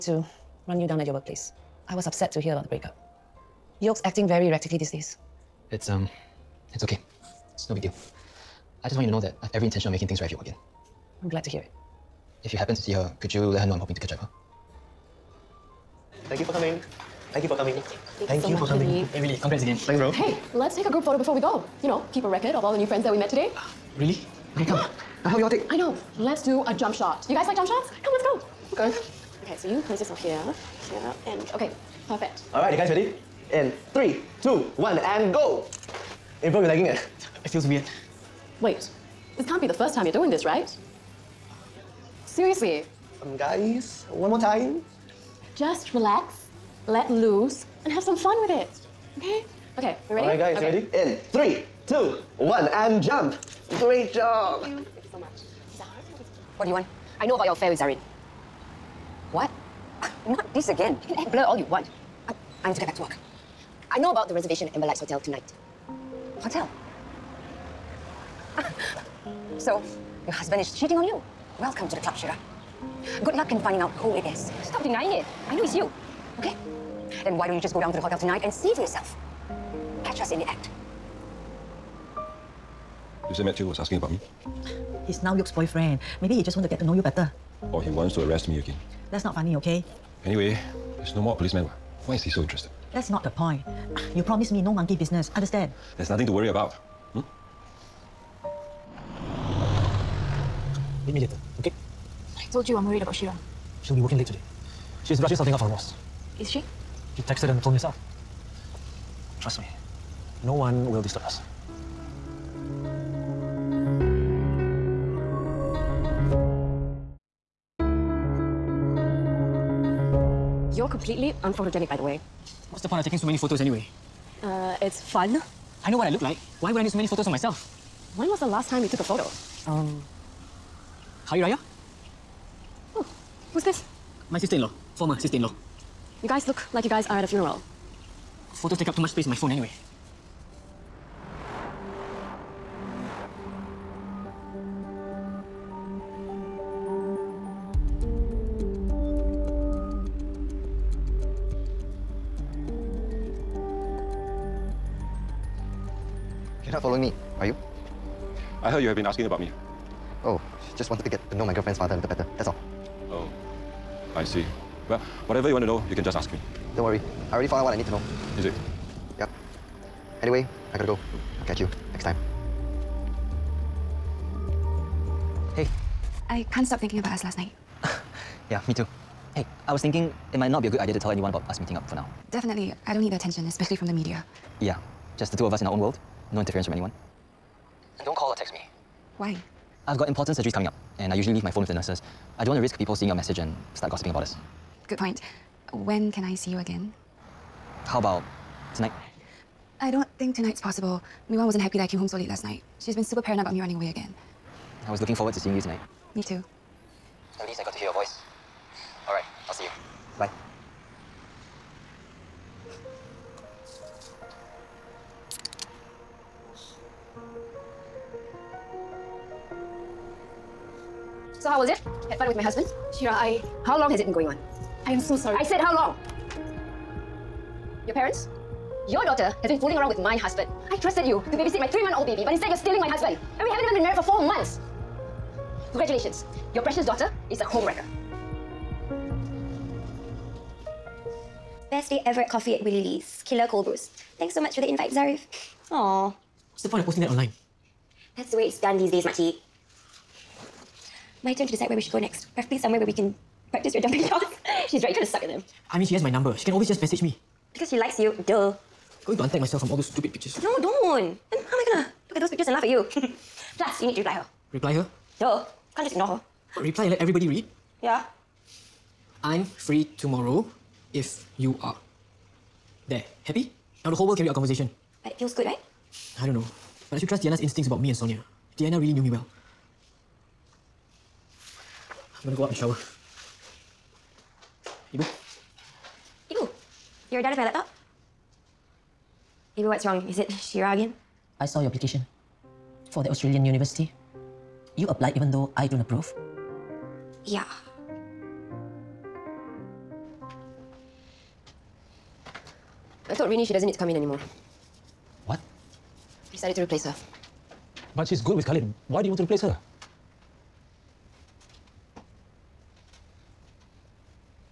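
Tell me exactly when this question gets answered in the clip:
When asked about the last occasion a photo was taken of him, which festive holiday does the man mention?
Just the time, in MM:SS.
02:11.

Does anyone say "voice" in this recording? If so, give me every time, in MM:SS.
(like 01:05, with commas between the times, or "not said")
03:27.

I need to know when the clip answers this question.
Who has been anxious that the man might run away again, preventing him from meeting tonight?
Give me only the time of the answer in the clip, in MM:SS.
03:21.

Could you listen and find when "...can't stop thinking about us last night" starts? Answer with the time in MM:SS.
02:56.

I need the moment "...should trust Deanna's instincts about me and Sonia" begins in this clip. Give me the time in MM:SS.
04:36.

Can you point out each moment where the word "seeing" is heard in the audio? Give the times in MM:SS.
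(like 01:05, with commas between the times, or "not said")
03:12, 03:25.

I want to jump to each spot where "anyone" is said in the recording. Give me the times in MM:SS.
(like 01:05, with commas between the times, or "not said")
03:01, 03:06.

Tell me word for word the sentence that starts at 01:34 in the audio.
You promised me no monkey business, understand?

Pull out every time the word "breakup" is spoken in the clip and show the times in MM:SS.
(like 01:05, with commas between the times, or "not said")
00:02.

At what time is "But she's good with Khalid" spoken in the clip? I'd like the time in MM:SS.
05:07.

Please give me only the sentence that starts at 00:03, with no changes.
Yoke's acting very erratically these days.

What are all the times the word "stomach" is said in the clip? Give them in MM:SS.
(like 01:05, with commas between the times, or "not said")
not said.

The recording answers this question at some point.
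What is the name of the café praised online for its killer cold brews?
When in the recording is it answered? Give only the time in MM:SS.
04:02.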